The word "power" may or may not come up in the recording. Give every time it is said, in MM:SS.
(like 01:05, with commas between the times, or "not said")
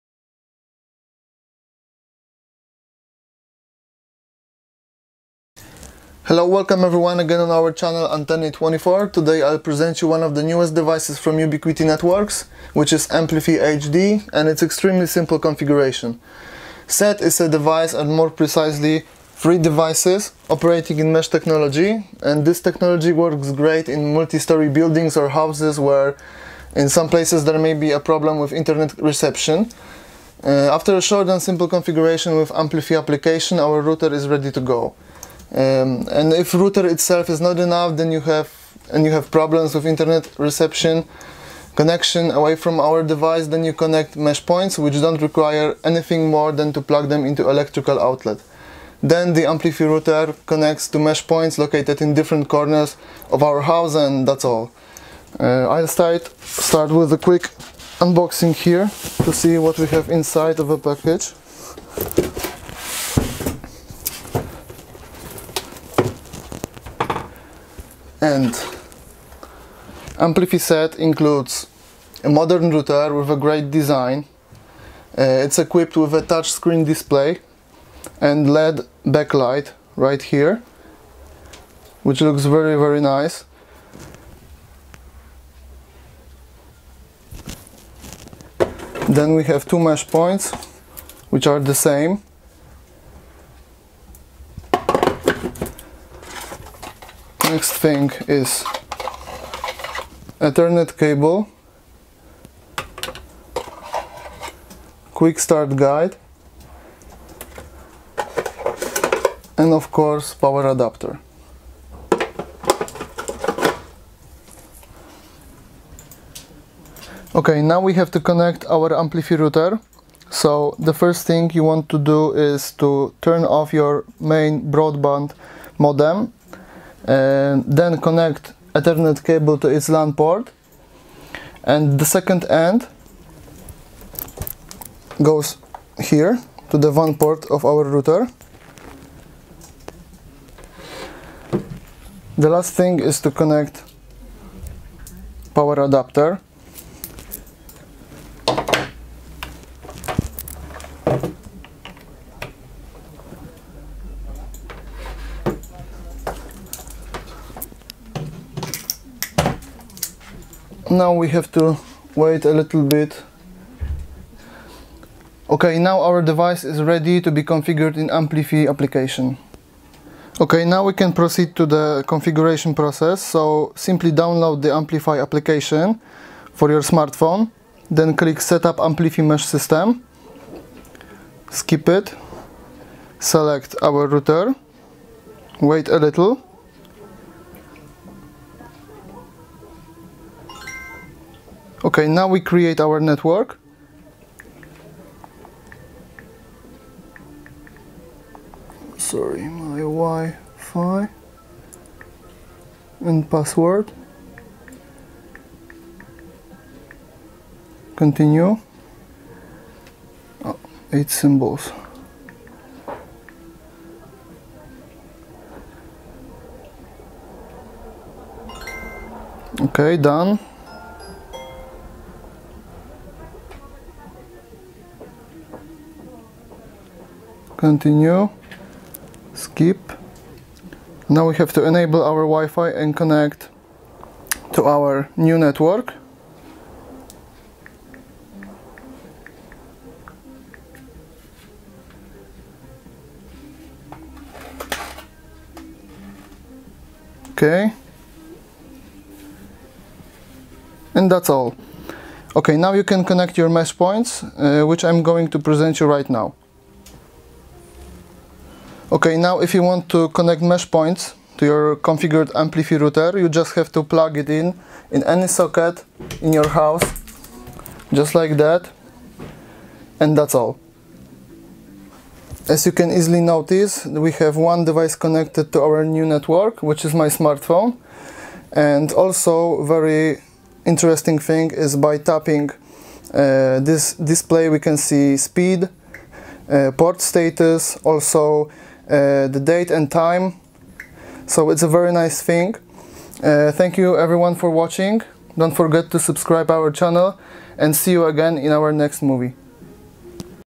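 01:50, 02:25.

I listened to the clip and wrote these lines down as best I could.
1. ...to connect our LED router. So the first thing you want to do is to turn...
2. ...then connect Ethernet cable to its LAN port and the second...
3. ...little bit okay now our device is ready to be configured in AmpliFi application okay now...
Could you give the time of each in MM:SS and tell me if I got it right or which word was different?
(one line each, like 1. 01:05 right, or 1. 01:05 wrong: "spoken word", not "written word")
1. 01:58 wrong: "AmpliFi", not "LED"
2. 02:07 right
3. 02:42 right.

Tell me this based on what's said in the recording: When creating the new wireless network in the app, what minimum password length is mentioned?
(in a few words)
8 symbols.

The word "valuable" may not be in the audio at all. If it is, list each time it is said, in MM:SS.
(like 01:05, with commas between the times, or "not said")
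not said.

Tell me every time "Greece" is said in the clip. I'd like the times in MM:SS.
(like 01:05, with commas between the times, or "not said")
not said.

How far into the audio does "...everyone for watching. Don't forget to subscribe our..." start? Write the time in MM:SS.
04:53.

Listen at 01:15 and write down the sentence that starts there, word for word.
Uh, it's equipped with a touchscreen display and LED backlight right here, which looks very, very nice.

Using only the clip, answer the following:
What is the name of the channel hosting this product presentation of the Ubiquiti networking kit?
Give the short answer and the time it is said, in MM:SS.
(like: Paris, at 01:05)
Anteny24, at 00:08.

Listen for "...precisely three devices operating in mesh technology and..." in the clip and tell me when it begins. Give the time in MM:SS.
00:18.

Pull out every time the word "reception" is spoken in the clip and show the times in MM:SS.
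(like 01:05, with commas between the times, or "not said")
00:28, 00:40.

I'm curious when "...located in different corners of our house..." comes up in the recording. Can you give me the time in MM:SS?
00:51.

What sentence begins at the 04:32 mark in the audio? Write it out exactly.
As you can easily notice, we have one device connected to our new network, which is my smartphone.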